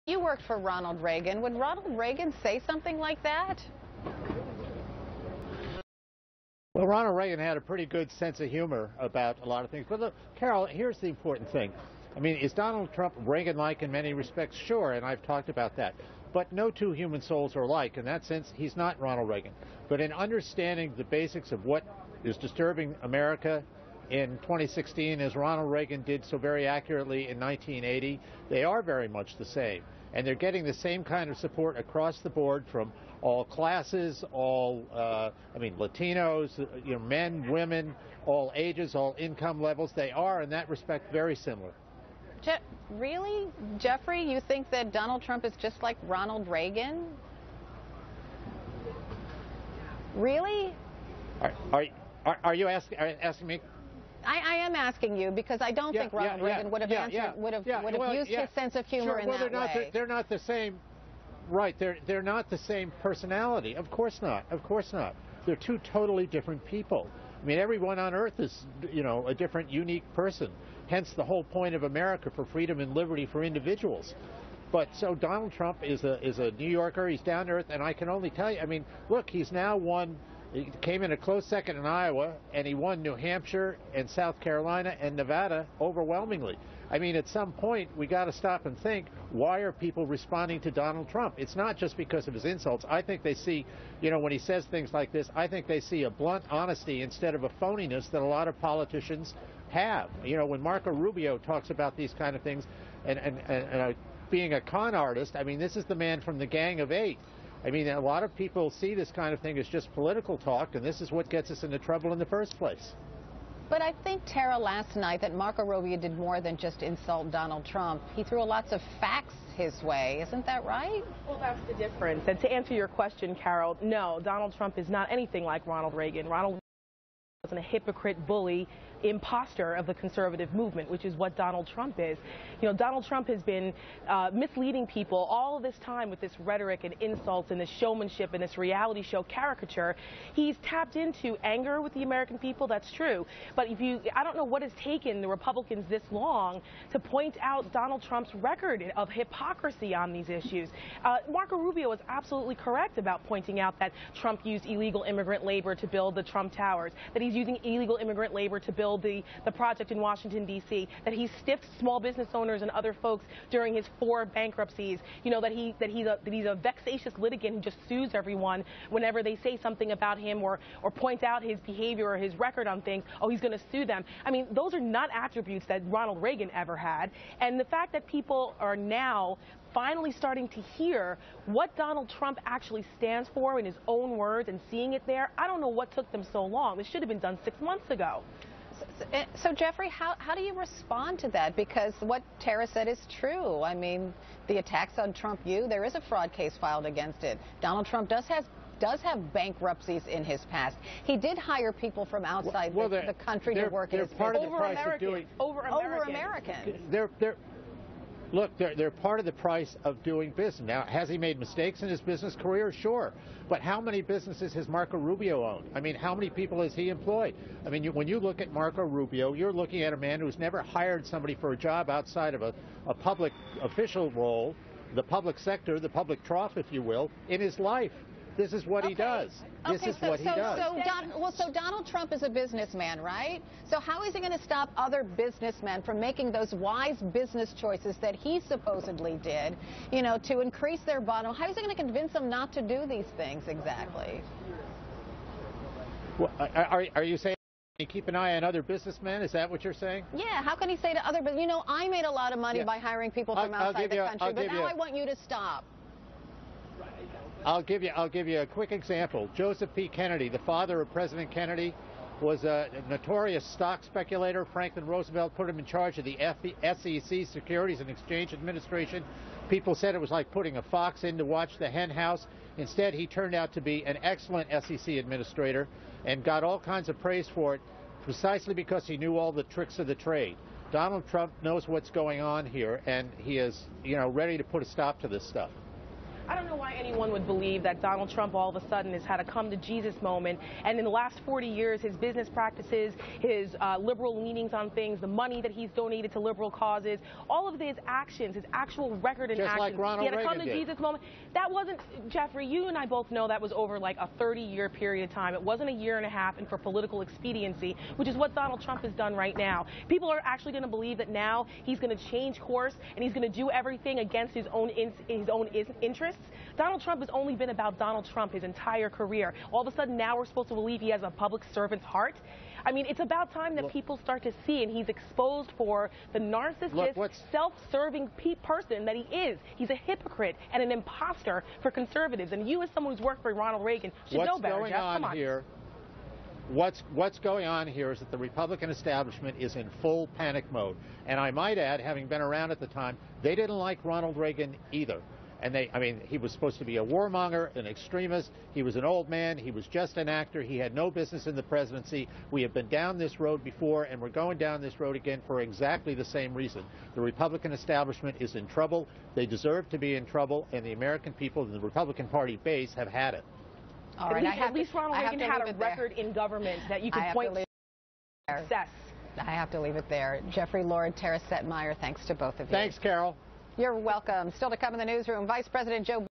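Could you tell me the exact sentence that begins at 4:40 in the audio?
Donald Trump knows what's going on here, and he is, you know, ready to put a stop to this stuff.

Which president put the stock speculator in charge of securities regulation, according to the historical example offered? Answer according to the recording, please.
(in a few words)
Franklin Roosevelt.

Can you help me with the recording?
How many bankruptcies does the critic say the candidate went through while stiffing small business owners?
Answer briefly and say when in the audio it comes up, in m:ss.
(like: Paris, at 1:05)
4, at 2:43.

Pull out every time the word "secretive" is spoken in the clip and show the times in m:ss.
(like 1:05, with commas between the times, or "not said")
not said.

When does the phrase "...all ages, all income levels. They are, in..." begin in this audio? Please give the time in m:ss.
0:38.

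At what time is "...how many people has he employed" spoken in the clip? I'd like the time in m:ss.
3:35.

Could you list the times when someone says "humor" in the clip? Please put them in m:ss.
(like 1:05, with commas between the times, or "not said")
0:08, 0:58.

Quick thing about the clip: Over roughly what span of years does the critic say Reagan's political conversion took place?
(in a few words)
30 years.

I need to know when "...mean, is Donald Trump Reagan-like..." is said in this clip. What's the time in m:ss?
0:12.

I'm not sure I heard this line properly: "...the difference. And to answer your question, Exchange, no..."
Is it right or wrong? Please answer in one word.
wrong.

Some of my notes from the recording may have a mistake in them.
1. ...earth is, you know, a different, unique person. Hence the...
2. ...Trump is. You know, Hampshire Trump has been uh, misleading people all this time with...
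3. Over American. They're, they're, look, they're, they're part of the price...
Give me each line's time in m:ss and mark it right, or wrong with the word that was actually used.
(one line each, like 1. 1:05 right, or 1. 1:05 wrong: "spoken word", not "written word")
1. 1:08 right
2. 2:11 wrong: "Donald", not "Hampshire"
3. 3:25 right.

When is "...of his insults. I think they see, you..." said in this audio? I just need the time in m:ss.
1:32.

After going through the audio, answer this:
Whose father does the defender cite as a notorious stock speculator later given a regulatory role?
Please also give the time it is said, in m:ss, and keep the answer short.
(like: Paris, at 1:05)
President Kennedy, at 4:20.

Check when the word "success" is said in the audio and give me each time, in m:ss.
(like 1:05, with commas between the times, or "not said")
6:08.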